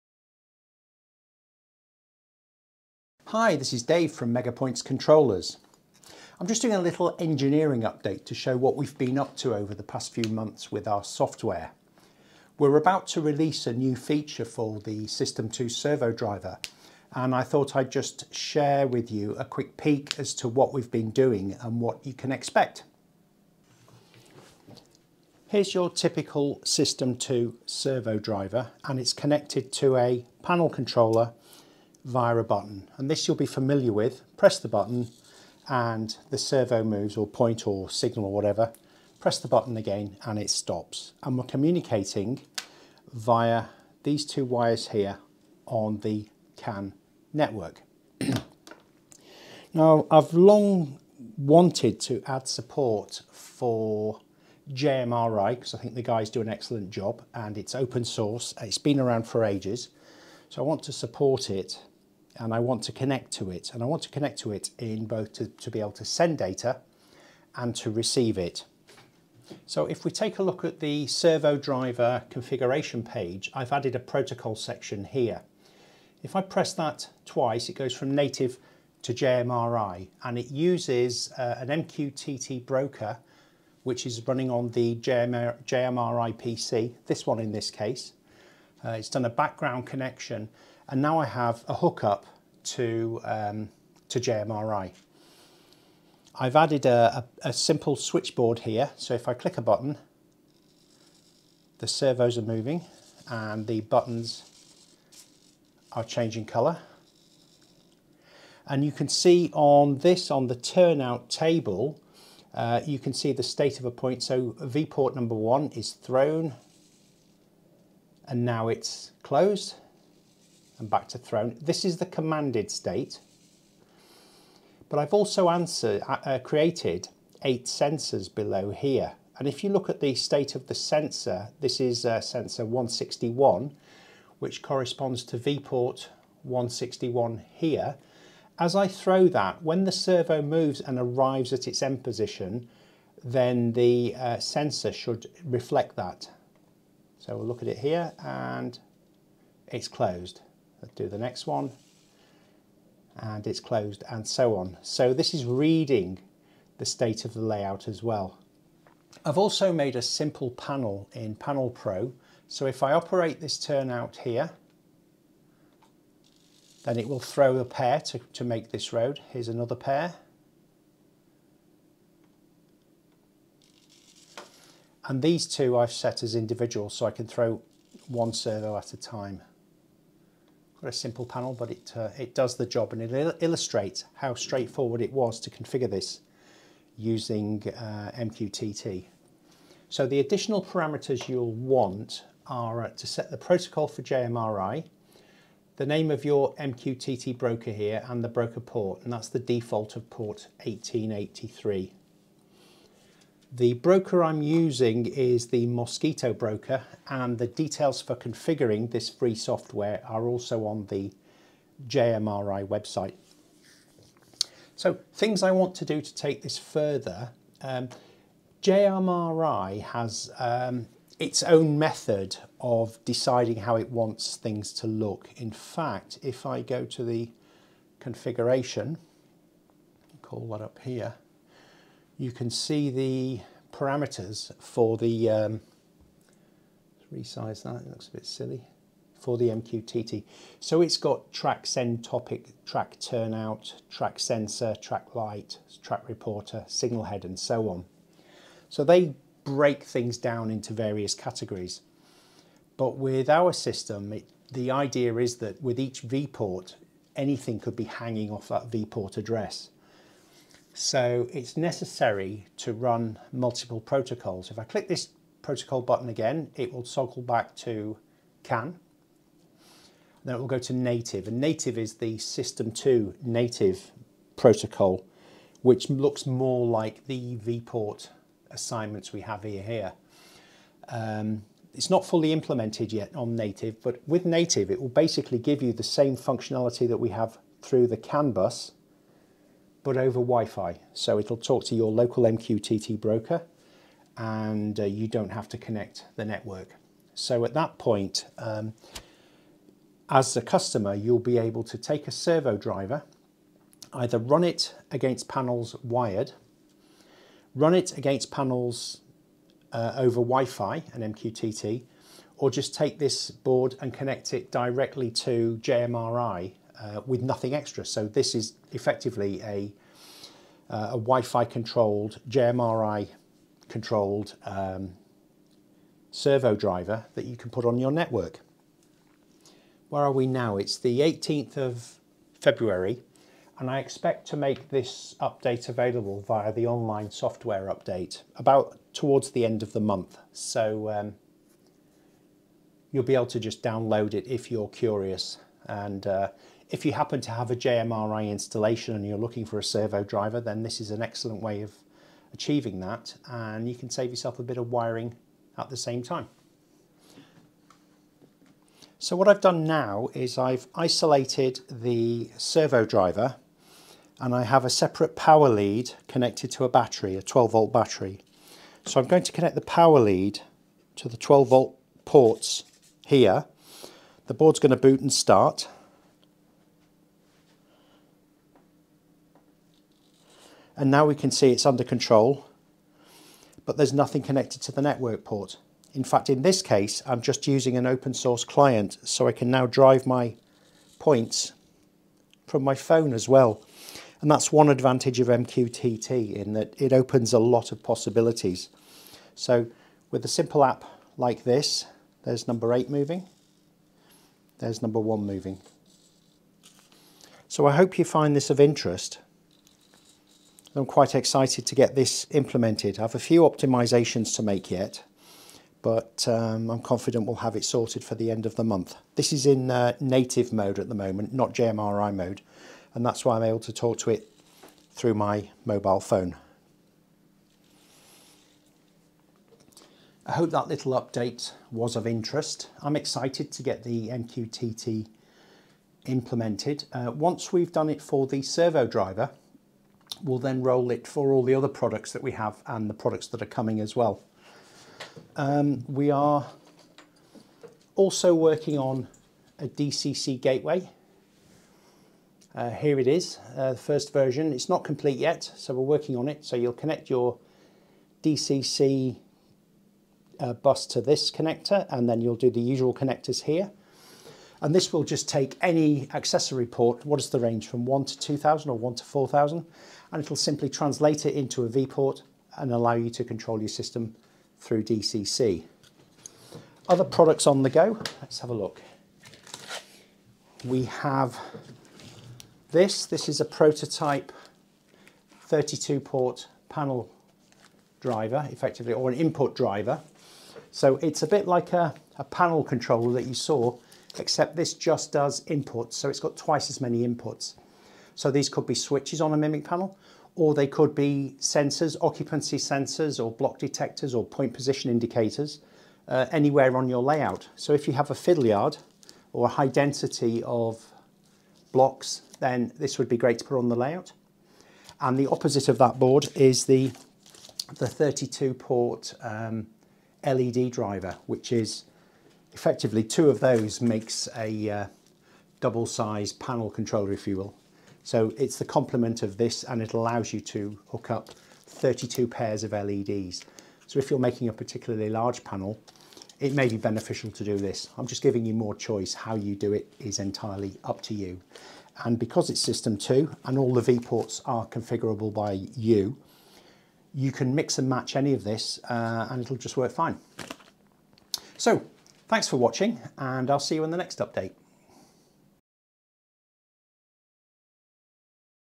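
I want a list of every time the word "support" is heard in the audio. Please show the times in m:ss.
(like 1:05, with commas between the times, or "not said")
0:52, 1:00.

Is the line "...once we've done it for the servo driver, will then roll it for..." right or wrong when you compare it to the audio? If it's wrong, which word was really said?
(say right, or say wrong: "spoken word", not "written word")
right.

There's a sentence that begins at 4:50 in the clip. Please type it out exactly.
So it'll talk to your local MQTT broker and uh, you don't have to connect the network.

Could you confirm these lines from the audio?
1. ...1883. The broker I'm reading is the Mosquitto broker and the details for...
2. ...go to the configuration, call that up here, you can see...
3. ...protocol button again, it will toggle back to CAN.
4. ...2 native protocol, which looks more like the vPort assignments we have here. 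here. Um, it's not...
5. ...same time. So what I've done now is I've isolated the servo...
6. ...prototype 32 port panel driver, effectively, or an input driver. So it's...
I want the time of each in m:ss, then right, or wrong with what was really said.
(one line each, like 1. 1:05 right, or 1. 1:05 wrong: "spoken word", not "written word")
1. 3:20 wrong: "using", not "reading"
2. 3:46 right
3. 4:25 right
4. 4:32 right
5. 5:55 right
6. 8:03 right.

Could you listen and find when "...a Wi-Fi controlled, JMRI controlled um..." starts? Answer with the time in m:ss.
5:20.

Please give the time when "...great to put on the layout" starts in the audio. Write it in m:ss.
8:33.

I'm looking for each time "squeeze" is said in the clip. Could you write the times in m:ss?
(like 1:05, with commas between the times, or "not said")
not said.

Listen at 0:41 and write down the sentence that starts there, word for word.
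And we're communicating via these two wires here on the CAN network.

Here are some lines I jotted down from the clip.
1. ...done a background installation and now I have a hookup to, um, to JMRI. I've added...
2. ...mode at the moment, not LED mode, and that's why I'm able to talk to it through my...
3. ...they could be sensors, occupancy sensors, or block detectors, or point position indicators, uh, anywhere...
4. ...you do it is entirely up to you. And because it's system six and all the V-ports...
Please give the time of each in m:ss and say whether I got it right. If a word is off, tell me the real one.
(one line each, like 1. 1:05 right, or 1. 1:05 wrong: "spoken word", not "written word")
1. 1:29 wrong: "connection", not "installation"
2. 7:00 wrong: "JMRI", not "LED"
3. 8:20 right
4. 8:59 wrong: "two", not "six".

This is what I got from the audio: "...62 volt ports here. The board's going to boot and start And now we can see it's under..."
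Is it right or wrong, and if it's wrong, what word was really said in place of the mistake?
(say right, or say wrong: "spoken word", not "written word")
wrong: "12", not "62".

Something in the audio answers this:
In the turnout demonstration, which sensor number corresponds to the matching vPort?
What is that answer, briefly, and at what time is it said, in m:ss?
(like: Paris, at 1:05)
161, at 2:12.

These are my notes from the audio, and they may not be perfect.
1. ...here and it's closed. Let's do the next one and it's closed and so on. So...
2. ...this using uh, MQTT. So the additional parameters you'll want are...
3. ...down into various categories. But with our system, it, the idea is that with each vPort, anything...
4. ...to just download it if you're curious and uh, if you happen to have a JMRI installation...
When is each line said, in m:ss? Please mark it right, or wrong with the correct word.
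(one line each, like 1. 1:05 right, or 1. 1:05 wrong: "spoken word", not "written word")
1. 2:27 right
2. 3:05 right
3. 4:10 right
4. 5:43 right.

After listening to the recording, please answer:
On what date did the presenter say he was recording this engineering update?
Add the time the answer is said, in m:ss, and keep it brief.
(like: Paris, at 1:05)
18th of February, at 5:31.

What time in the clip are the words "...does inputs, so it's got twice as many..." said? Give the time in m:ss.
8:15.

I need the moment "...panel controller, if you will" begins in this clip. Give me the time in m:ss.
8:46.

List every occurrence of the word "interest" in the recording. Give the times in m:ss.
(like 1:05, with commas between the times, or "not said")
6:48, 7:12.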